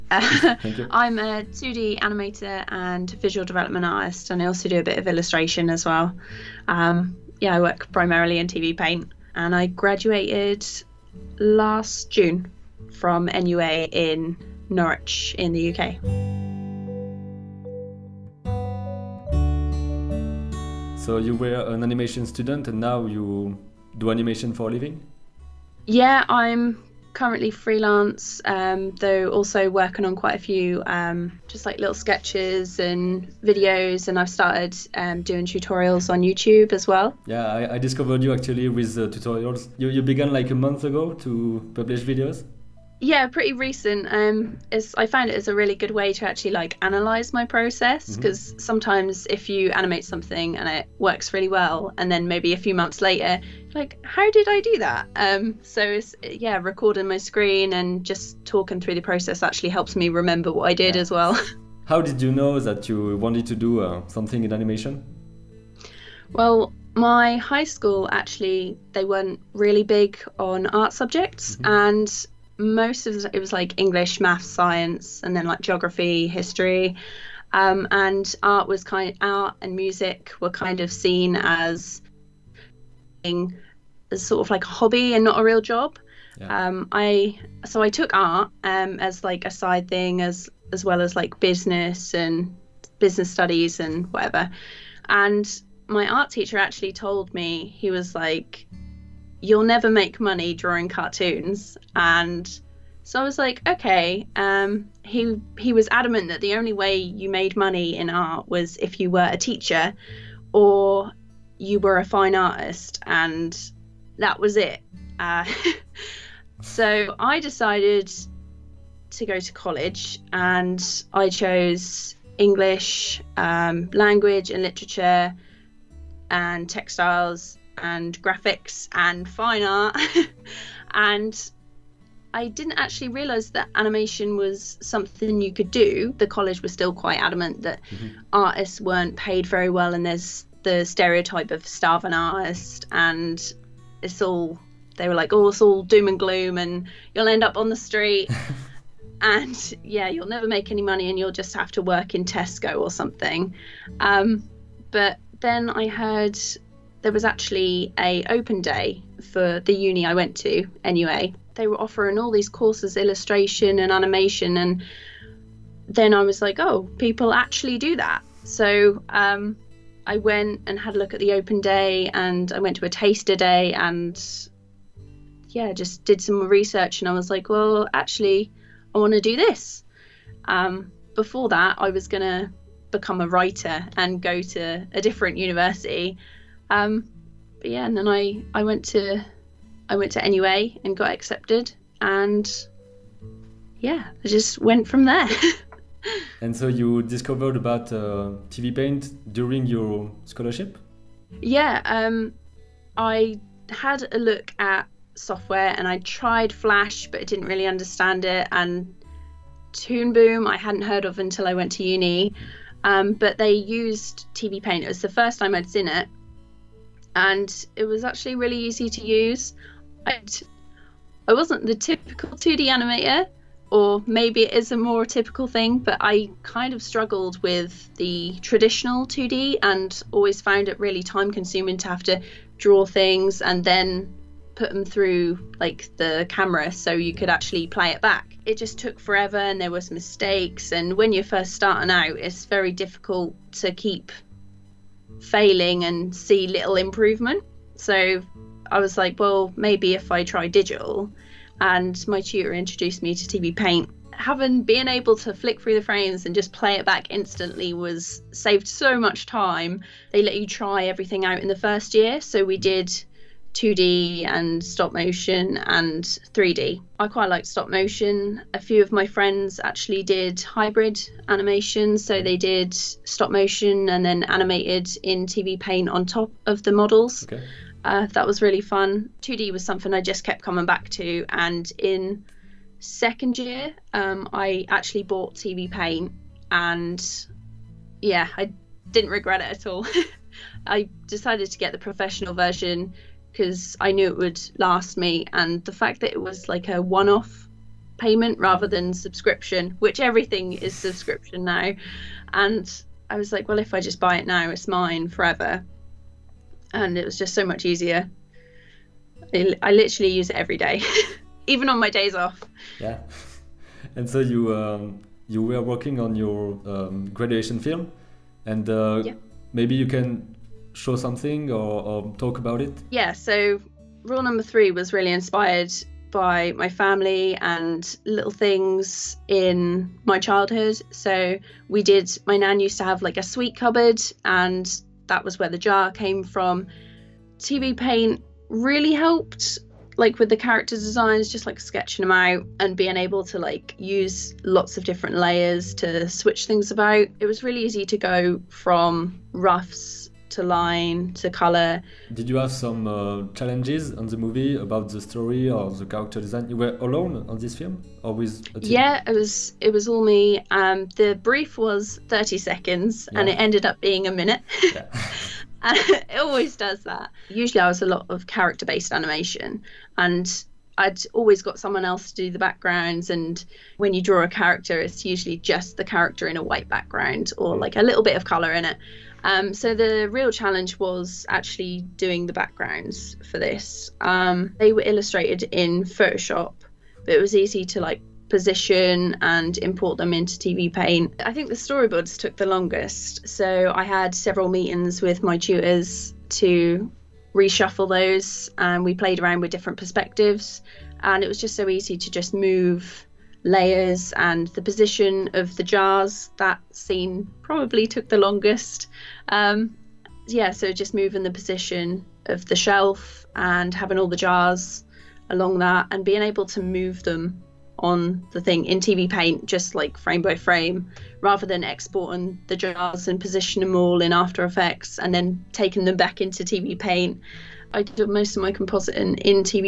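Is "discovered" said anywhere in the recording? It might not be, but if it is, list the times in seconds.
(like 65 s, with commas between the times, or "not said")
37 s, 197 s.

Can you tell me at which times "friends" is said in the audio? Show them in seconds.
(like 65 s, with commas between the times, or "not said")
269 s.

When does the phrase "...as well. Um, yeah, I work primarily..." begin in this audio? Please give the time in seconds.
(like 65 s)
5 s.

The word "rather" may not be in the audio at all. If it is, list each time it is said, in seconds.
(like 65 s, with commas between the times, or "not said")
298 s, 421 s.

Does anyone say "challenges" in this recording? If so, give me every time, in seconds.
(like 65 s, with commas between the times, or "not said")
353 s, 380 s.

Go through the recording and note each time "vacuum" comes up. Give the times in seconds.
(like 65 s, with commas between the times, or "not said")
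not said.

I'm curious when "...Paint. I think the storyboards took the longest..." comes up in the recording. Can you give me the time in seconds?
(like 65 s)
390 s.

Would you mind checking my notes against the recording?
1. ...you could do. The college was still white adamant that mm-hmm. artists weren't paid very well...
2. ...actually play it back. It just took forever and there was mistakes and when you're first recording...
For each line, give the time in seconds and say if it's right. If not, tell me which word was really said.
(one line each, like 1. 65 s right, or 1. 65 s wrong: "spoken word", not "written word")
1. 135 s wrong: "quite", not "white"
2. 237 s wrong: "starting", not "recording".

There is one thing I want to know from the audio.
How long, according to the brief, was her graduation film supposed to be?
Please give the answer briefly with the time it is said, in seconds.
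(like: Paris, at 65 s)
30 seconds, at 362 s.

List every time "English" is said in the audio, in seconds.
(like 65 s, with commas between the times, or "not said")
73 s, 122 s.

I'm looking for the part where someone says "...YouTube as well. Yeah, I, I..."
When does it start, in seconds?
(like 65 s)
36 s.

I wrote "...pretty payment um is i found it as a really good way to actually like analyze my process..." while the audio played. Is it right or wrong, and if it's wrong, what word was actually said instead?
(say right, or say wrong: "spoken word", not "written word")
wrong: "recent", not "payment".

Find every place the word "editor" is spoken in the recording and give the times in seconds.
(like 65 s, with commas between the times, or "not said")
not said.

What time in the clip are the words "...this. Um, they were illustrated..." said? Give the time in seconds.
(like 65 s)
383 s.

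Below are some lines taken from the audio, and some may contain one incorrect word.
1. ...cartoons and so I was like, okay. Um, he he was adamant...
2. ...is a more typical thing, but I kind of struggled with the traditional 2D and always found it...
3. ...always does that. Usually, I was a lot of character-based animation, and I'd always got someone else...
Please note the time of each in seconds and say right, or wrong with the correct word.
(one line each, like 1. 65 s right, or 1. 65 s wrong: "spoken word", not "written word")
1. 100 s right
2. 224 s right
3. 366 s right.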